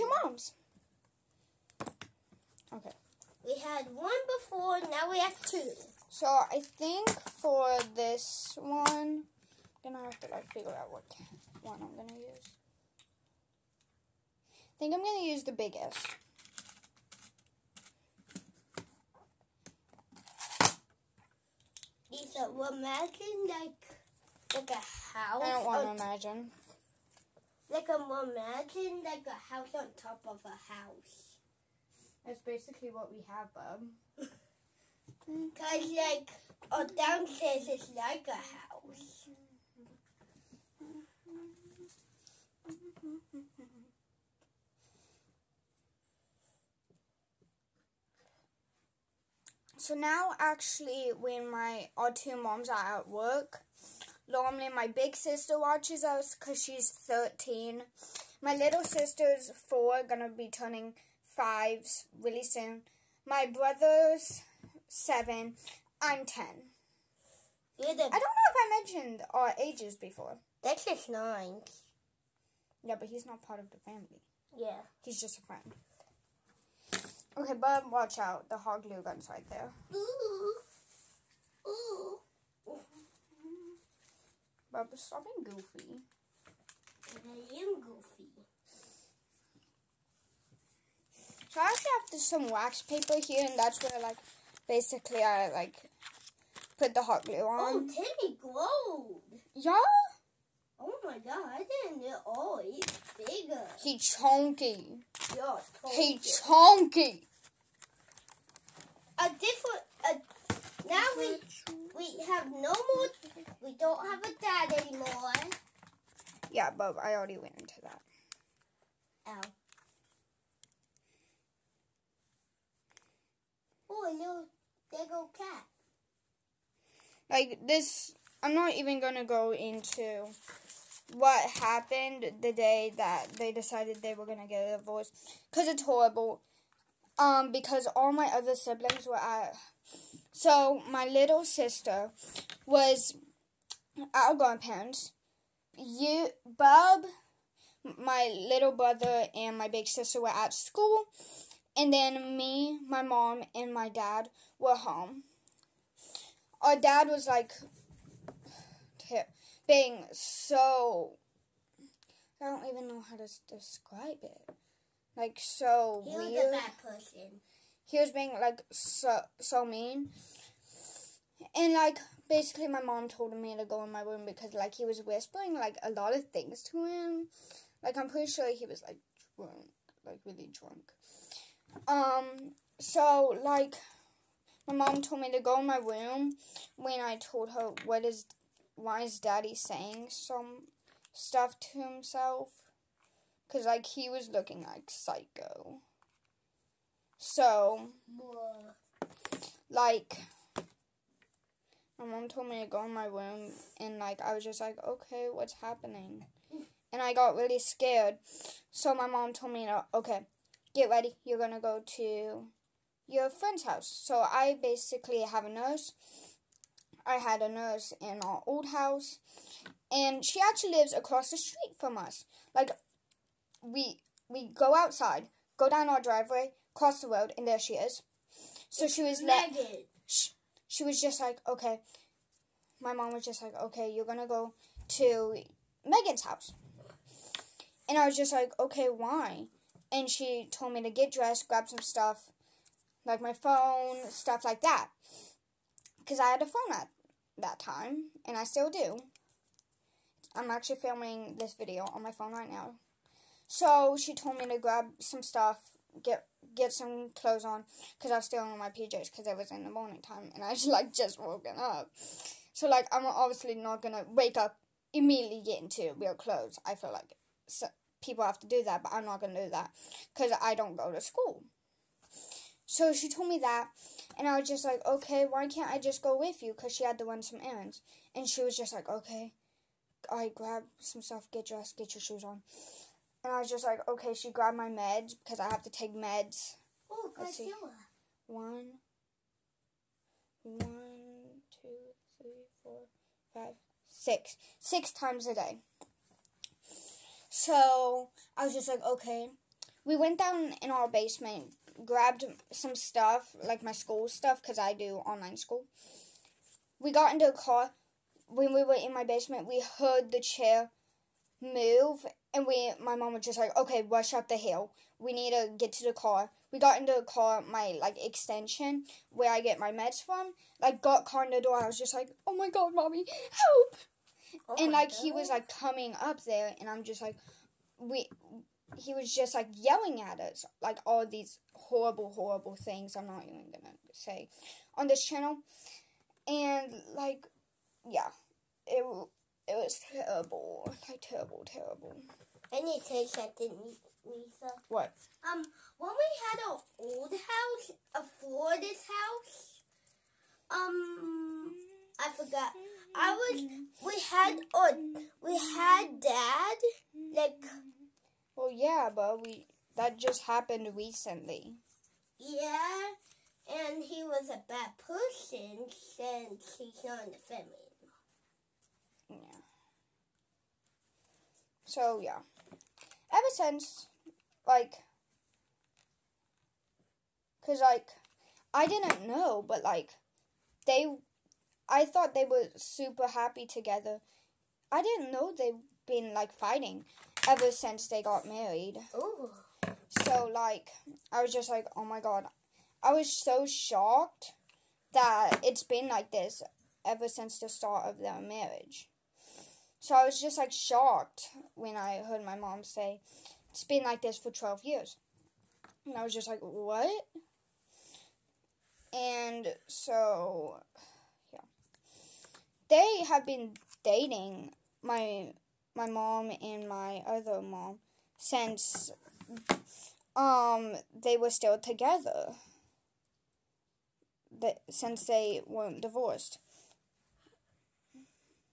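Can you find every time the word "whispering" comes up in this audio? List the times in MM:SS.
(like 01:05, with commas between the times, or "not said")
02:55.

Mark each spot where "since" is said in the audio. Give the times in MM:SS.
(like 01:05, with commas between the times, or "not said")
06:05, 06:13, 06:27, 06:37, 06:58, 07:04.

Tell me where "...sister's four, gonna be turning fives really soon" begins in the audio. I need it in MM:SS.
00:58.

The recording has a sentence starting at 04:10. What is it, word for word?
I'm actually filming this video on my phone right now.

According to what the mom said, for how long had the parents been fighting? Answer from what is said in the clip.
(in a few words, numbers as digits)
12 years.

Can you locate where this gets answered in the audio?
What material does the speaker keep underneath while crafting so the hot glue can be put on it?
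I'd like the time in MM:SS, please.
01:32.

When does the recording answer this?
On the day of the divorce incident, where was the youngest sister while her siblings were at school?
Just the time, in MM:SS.
02:24.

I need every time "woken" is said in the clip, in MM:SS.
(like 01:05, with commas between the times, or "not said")
04:21.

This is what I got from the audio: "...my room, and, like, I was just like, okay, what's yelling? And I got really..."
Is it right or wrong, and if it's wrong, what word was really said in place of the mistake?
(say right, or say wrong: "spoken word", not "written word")
wrong: "happening", not "yelling".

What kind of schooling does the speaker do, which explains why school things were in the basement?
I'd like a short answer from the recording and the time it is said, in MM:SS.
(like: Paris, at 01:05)
Online school, at 05:05.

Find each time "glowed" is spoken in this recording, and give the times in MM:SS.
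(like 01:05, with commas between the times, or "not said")
01:38.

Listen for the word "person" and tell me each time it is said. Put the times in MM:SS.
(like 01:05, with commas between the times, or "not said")
02:46, 06:04.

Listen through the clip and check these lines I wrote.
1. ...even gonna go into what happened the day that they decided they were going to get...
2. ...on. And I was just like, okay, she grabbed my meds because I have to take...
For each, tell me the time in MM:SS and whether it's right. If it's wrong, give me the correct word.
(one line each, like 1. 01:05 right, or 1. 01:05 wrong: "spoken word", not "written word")
1. 02:08 right
2. 04:42 right.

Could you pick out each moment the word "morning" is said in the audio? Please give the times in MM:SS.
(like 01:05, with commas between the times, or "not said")
04:19.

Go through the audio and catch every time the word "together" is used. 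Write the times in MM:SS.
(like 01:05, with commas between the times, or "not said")
06:23, 07:01.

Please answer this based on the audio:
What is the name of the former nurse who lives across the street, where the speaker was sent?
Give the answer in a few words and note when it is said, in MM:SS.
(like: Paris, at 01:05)
Megan, at 03:55.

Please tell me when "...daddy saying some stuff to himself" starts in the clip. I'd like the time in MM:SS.
03:09.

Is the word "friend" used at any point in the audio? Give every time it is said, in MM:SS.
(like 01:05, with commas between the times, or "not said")
01:15, 03:33.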